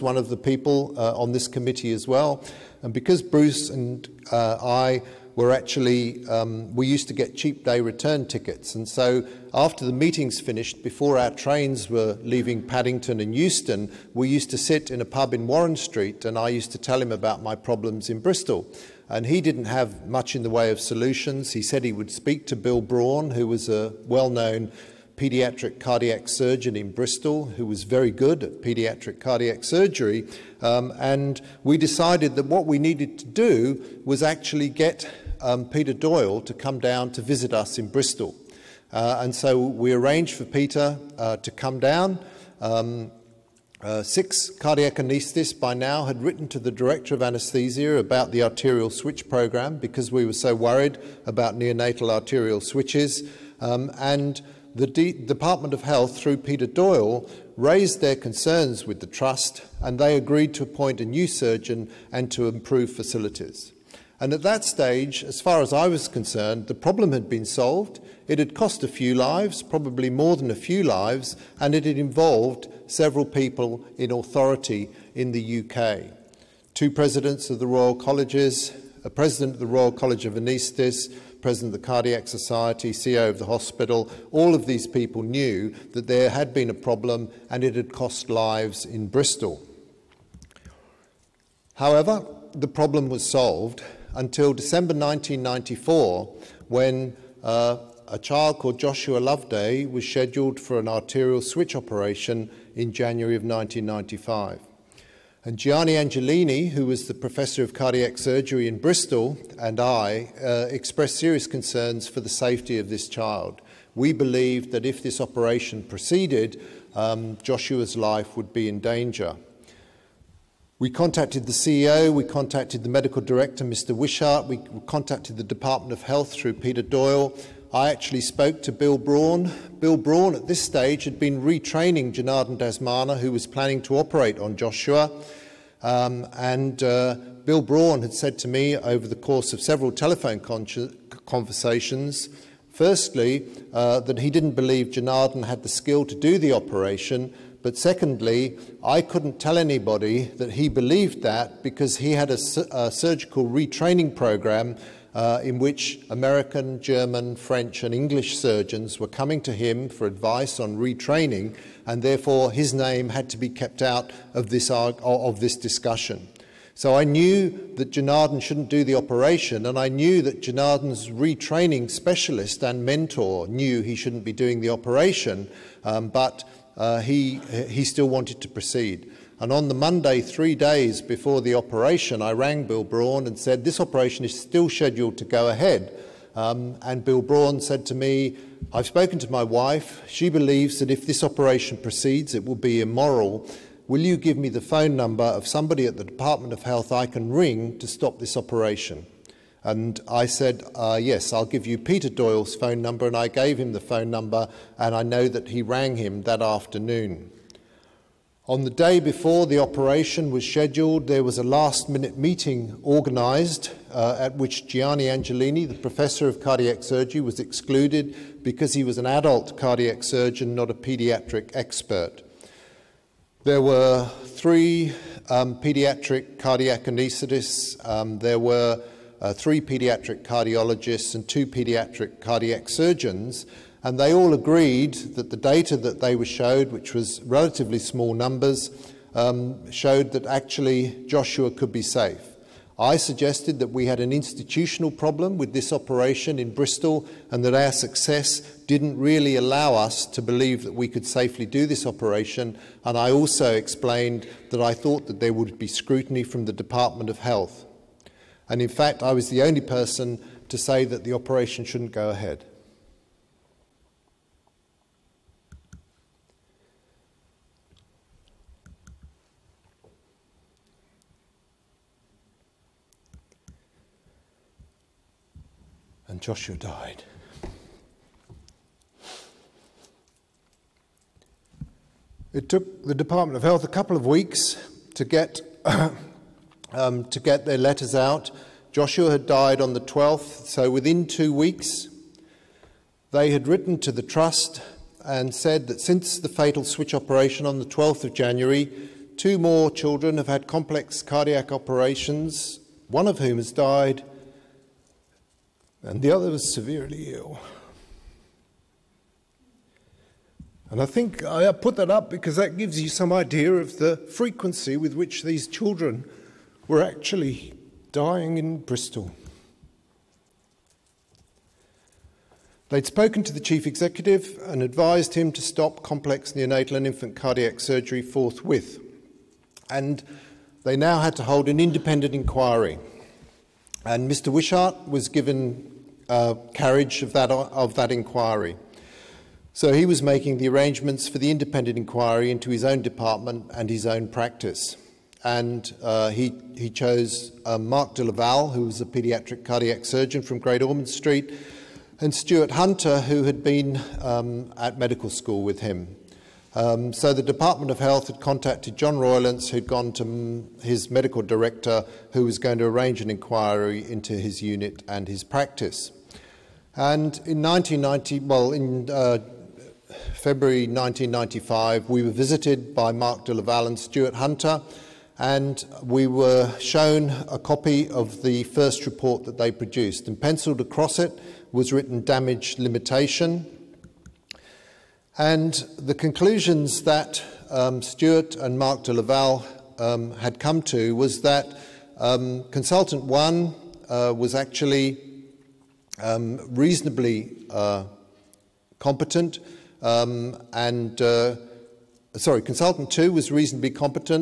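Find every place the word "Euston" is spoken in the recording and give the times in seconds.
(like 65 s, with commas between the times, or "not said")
13 s.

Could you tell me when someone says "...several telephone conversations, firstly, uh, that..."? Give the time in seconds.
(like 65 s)
139 s.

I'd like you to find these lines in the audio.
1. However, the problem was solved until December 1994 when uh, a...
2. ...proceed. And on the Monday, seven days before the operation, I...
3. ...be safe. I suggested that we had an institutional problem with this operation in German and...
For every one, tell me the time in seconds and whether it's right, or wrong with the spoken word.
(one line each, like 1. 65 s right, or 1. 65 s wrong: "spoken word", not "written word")
1. 91 s right
2. 178 s wrong: "three", not "seven"
3. 241 s wrong: "Bristol", not "German".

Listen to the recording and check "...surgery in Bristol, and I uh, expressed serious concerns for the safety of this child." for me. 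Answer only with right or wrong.
right.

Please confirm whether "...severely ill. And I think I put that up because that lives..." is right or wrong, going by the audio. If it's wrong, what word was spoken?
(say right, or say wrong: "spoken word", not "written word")
wrong: "gives", not "lives".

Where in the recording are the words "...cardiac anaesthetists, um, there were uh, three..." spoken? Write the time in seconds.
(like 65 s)
226 s.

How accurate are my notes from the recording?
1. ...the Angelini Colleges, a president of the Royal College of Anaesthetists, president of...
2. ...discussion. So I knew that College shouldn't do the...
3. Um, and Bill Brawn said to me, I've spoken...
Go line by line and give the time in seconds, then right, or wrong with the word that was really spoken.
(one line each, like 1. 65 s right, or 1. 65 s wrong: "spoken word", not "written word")
1. 77 s wrong: "Royal", not "Angelini"
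2. 165 s wrong: "Janardan", not "College"
3. 186 s right.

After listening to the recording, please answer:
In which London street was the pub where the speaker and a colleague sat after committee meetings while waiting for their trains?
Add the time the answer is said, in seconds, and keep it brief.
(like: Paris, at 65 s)
Warren Street, at 15 s.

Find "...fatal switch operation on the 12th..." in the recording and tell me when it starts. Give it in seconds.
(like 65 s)
296 s.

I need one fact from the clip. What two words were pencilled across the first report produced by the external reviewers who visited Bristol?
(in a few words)
damage limitation.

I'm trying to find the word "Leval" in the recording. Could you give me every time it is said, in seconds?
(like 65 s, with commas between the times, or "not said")
348 s, 373 s, 388 s.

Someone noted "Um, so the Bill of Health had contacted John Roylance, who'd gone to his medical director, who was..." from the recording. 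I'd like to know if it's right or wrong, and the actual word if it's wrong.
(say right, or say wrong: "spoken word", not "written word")
wrong: "Department", not "Bill".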